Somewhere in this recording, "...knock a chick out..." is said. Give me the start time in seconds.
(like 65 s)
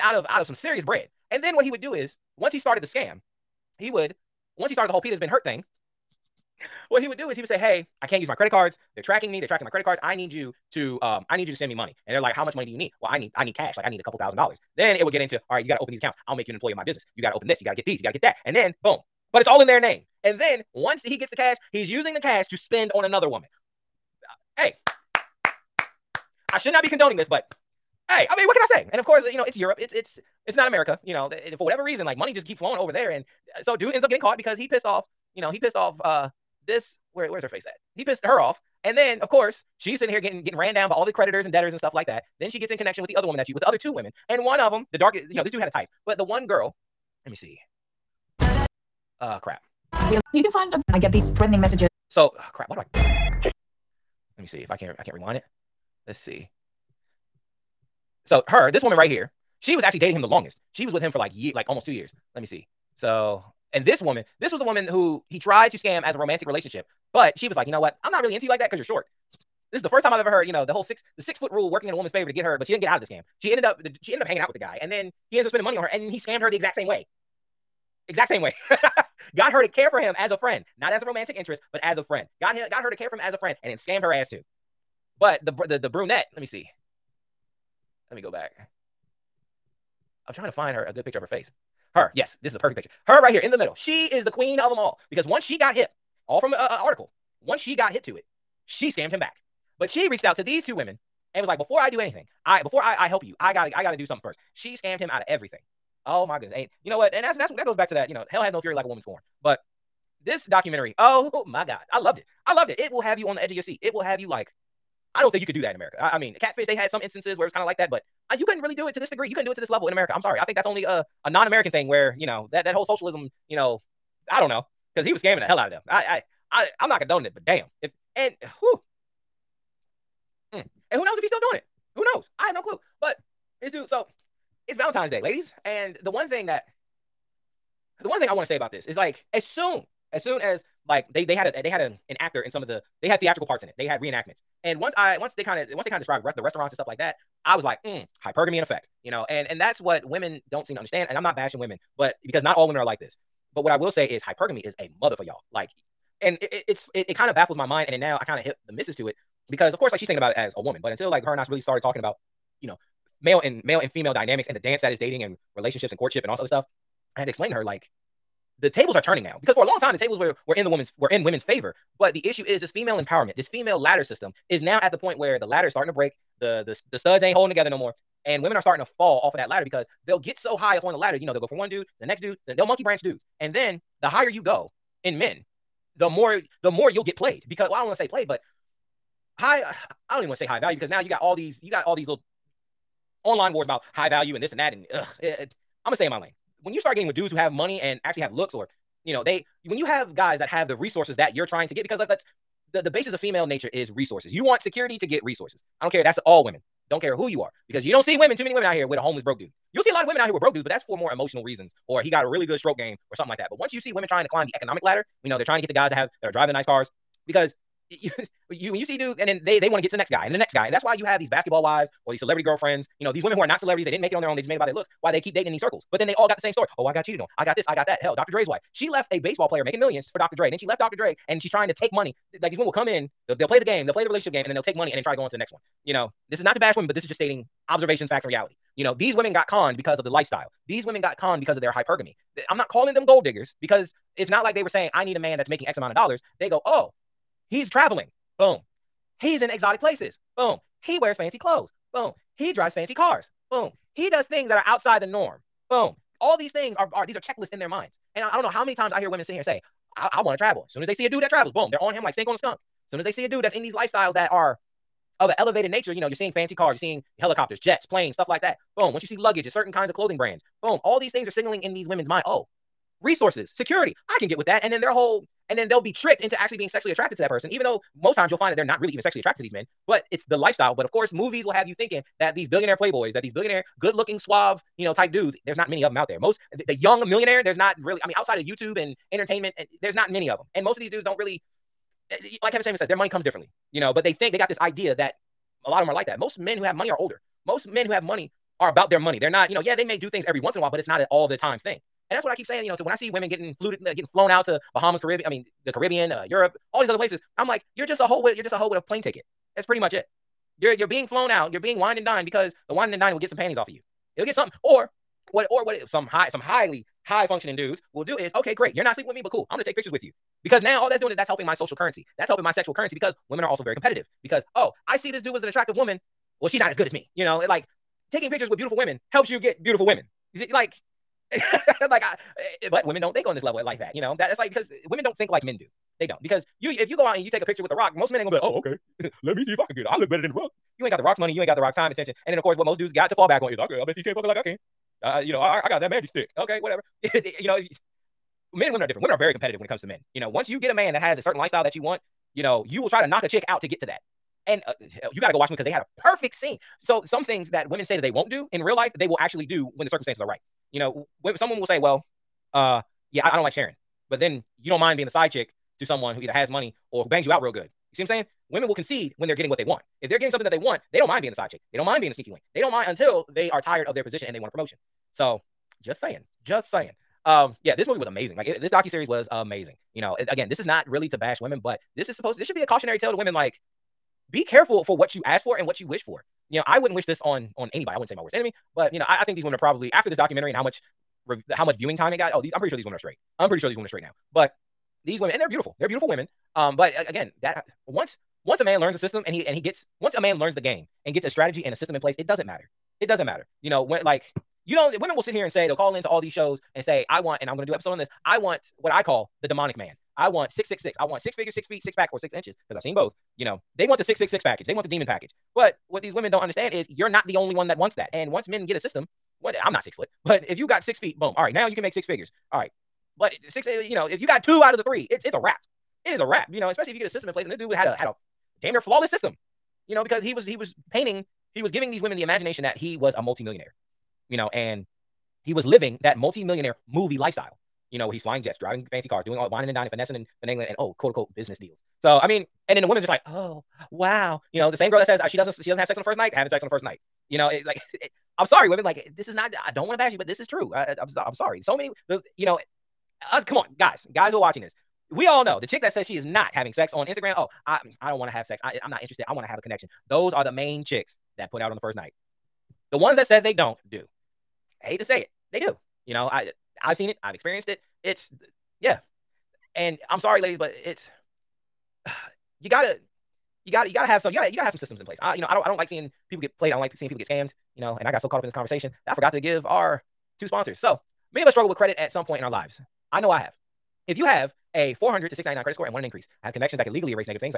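353 s.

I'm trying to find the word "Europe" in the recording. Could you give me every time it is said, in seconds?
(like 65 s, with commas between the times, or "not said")
29 s, 306 s.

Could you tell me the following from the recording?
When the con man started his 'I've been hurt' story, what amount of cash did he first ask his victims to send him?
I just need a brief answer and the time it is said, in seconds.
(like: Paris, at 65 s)
a couple thousand dollars, at 14 s.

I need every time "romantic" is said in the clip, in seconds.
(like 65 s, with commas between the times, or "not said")
66 s, 81 s.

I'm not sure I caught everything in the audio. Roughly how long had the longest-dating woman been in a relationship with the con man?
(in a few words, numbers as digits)
almost two years.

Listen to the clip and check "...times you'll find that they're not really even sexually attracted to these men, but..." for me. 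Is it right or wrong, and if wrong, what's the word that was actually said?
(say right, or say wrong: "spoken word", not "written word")
right.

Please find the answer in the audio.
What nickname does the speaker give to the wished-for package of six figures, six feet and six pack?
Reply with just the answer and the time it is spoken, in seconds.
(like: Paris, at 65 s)
the demon package, at 414 s.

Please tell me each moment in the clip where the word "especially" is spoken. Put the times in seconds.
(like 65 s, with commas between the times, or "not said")
426 s.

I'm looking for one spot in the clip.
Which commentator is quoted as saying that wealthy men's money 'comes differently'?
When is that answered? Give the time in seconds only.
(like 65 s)
292 s.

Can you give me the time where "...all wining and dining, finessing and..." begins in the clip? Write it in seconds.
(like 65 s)
439 s.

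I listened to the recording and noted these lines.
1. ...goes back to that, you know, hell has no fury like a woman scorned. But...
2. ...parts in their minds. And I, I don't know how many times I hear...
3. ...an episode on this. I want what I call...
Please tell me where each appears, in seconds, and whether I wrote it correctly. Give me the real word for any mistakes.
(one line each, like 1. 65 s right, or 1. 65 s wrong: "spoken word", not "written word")
1. 107 s right
2. 257 s wrong: "checklists", not "parts"
3. 407 s right.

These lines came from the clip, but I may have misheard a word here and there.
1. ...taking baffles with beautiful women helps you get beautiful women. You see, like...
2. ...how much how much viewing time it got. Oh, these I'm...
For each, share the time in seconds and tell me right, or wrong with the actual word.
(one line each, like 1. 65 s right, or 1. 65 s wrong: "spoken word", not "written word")
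1. 328 s wrong: "pictures", not "baffles"
2. 390 s right.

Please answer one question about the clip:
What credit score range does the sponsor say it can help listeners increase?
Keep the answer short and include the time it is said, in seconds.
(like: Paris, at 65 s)
400 to 699, at 485 s.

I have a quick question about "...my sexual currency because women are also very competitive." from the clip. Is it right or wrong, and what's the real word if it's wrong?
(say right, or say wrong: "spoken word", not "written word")
right.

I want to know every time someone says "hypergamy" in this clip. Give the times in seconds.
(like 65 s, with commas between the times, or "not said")
148 s, 154 s, 241 s.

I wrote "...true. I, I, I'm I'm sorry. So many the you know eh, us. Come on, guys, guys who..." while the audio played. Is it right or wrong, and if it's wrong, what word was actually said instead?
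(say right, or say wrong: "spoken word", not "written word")
right.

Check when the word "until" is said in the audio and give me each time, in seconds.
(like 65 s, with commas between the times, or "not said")
160 s, 372 s.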